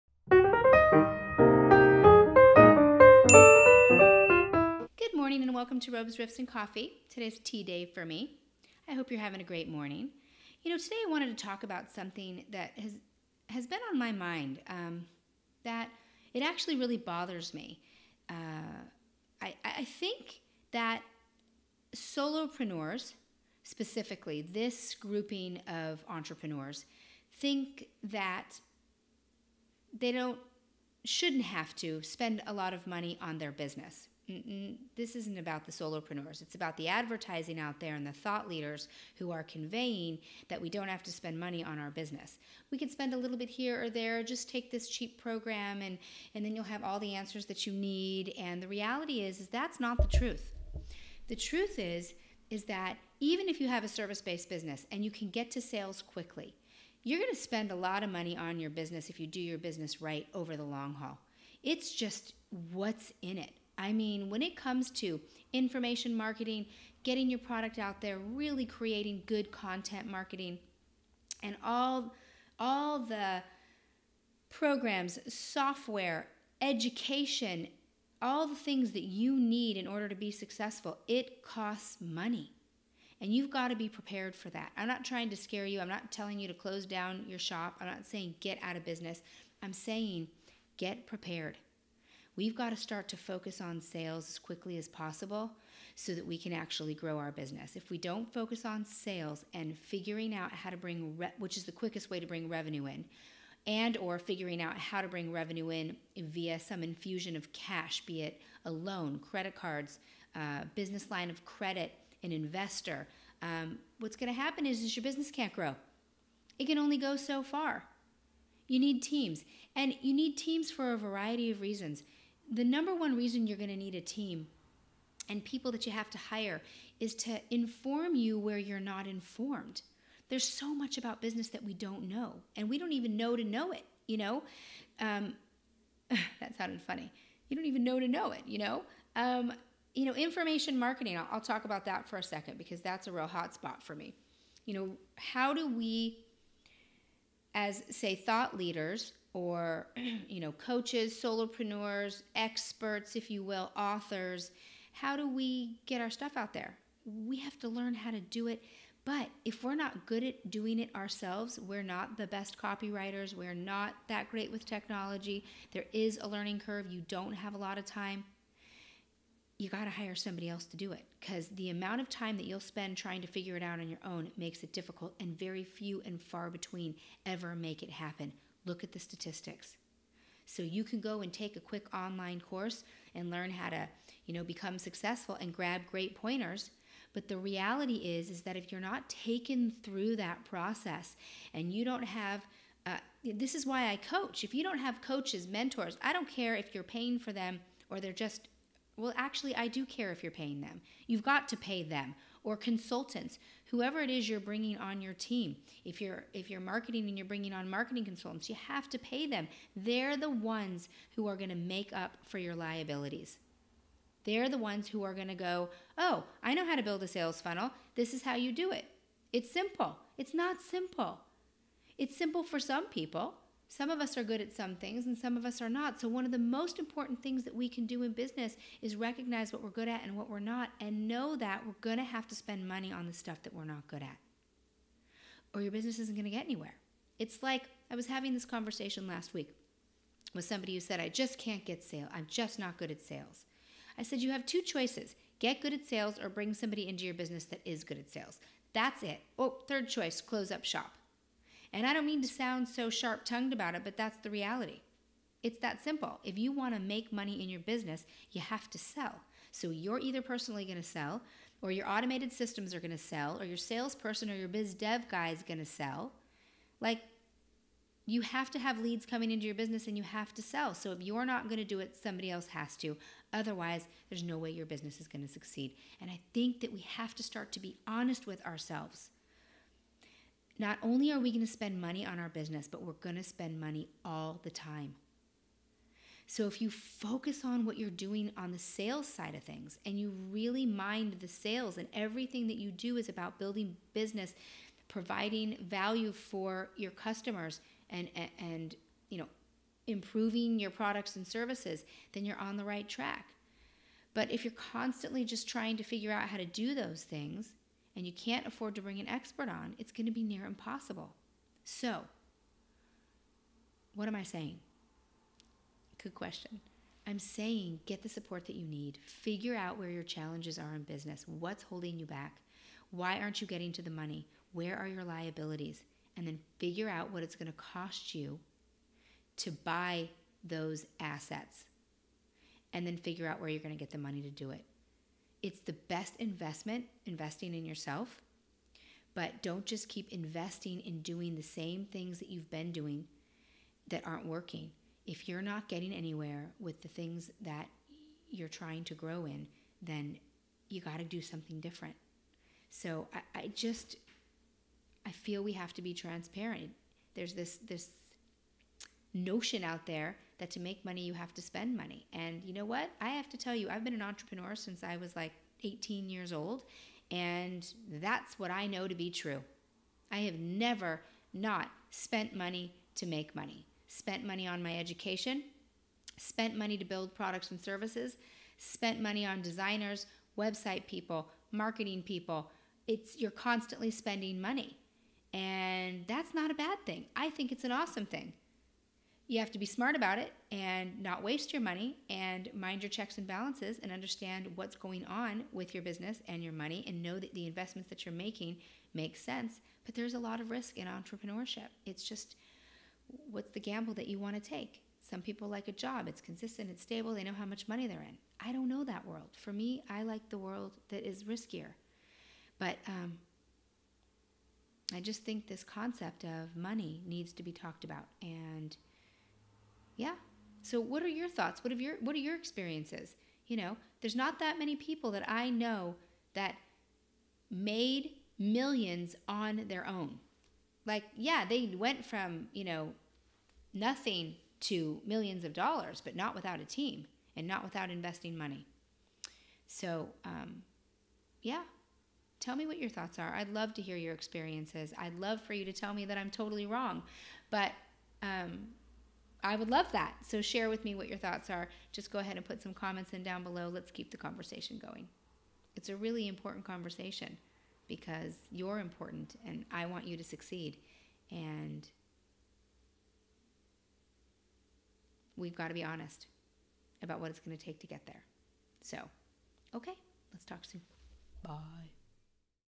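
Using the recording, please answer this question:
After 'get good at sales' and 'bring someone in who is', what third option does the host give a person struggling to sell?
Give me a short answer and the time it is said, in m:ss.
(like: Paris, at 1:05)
Close up shop, at 4:10.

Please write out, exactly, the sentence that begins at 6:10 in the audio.
I have never not spent money to make money.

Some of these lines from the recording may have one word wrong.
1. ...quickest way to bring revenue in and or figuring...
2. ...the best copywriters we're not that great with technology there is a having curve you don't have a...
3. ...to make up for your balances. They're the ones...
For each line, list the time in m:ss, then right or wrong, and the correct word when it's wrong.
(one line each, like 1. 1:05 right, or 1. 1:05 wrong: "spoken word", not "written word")
1. 1:41 right
2. 2:42 wrong: "learning", not "having"
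3. 3:31 wrong: "liabilities", not "balances".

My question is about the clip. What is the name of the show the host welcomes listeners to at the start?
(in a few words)
Robes, Riffs, and Coffee.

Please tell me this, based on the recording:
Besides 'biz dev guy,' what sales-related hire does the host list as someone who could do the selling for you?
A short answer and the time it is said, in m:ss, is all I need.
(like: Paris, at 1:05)
Salesperson, at 4:23.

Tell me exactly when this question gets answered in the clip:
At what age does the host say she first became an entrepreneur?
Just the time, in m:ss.
6:05.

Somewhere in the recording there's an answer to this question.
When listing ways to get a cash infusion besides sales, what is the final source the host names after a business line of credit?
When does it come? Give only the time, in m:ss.
1:52.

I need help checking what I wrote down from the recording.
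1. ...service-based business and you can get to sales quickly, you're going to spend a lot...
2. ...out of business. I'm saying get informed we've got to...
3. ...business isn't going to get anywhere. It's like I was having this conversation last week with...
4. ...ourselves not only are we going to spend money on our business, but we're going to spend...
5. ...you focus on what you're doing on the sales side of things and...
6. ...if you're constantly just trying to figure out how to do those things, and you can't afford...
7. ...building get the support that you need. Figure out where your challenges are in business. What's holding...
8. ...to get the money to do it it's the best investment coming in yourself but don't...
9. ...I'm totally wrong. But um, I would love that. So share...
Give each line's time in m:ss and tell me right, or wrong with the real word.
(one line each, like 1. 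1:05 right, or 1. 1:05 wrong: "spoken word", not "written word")
1. 0:53 right
2. 1:28 wrong: "prepared", not "informed"
3. 3:55 right
4. 4:38 right
5. 4:46 right
6. 5:04 right
7. 5:17 wrong: "saying", not "building"
8. 5:33 wrong: "investing", not "coming"
9. 7:26 right.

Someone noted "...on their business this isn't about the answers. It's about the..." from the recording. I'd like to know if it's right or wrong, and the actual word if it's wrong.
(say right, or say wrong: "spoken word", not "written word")
wrong: "solopreneurs", not "answers".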